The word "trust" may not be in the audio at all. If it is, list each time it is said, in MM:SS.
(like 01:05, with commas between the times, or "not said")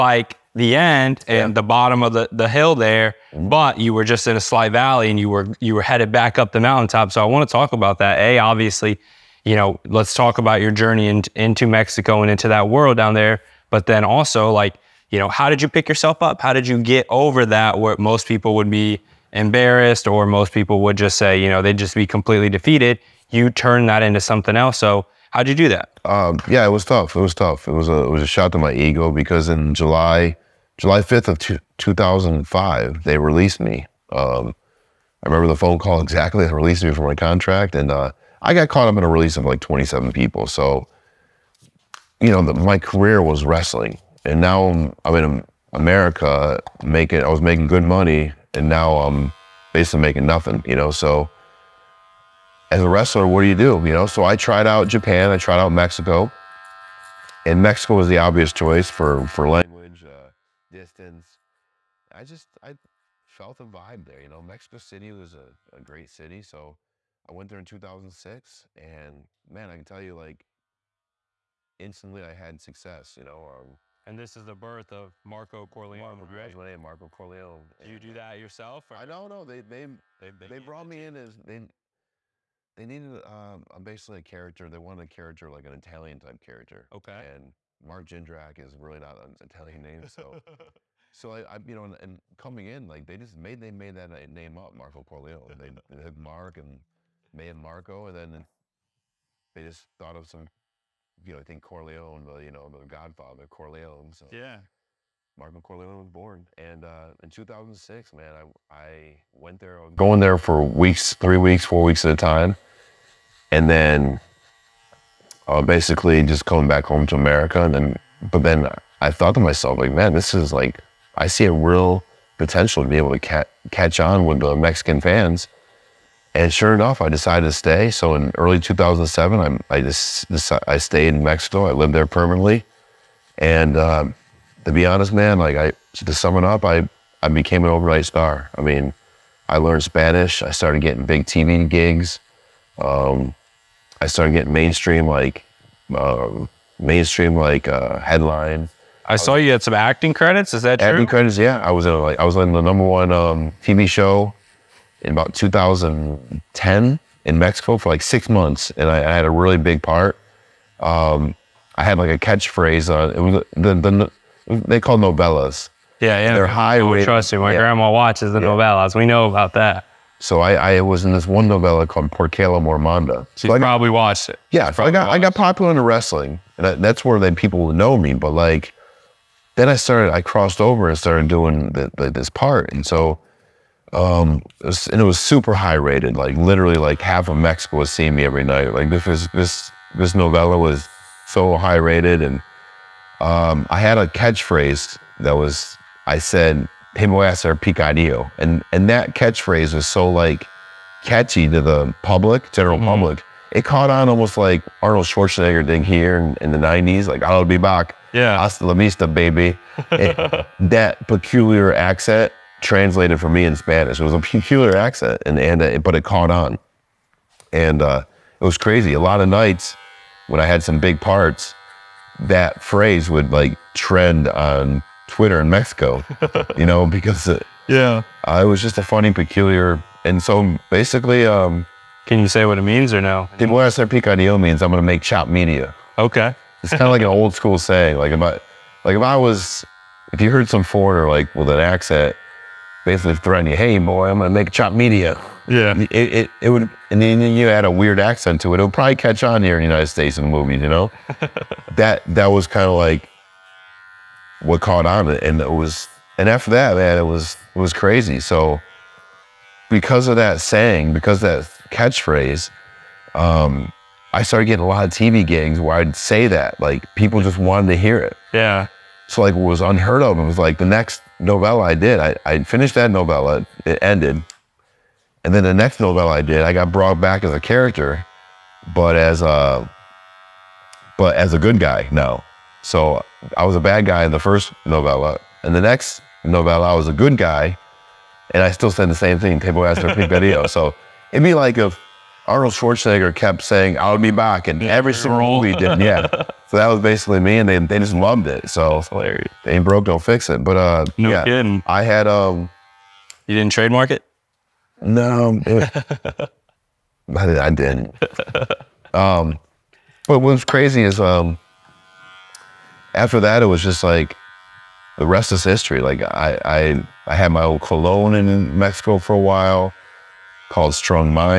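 02:47.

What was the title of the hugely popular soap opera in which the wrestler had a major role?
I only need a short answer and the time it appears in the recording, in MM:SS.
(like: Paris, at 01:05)
Porque el amor manda, at 02:52.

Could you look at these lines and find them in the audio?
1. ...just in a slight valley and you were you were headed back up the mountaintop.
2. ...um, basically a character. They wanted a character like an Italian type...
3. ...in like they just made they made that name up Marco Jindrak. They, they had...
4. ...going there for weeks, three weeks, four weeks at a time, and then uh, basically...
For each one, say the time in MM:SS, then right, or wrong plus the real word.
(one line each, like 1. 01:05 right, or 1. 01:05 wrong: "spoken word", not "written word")
1. 00:04 right
2. 01:23 right
3. 01:32 wrong: "Corleone", not "Jindrak"
4. 01:49 right.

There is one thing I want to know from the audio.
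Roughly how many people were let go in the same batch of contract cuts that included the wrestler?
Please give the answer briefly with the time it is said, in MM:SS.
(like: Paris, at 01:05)
27, at 00:39.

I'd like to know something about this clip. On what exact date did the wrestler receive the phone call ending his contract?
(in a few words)
July 5, 2005.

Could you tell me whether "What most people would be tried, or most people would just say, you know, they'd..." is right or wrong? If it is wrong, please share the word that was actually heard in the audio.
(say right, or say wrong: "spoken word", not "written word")
wrong: "embarrassed", not "tried".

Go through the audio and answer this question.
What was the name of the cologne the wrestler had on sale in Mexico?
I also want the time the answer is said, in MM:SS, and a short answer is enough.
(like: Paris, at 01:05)
Strong, at 05:20.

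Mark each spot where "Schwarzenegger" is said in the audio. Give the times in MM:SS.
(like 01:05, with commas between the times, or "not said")
03:25, 04:52.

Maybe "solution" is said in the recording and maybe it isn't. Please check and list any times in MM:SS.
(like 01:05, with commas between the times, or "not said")
not said.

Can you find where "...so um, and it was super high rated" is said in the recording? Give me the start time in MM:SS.
03:02.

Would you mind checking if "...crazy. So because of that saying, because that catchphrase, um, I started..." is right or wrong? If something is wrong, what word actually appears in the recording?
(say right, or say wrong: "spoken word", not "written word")
right.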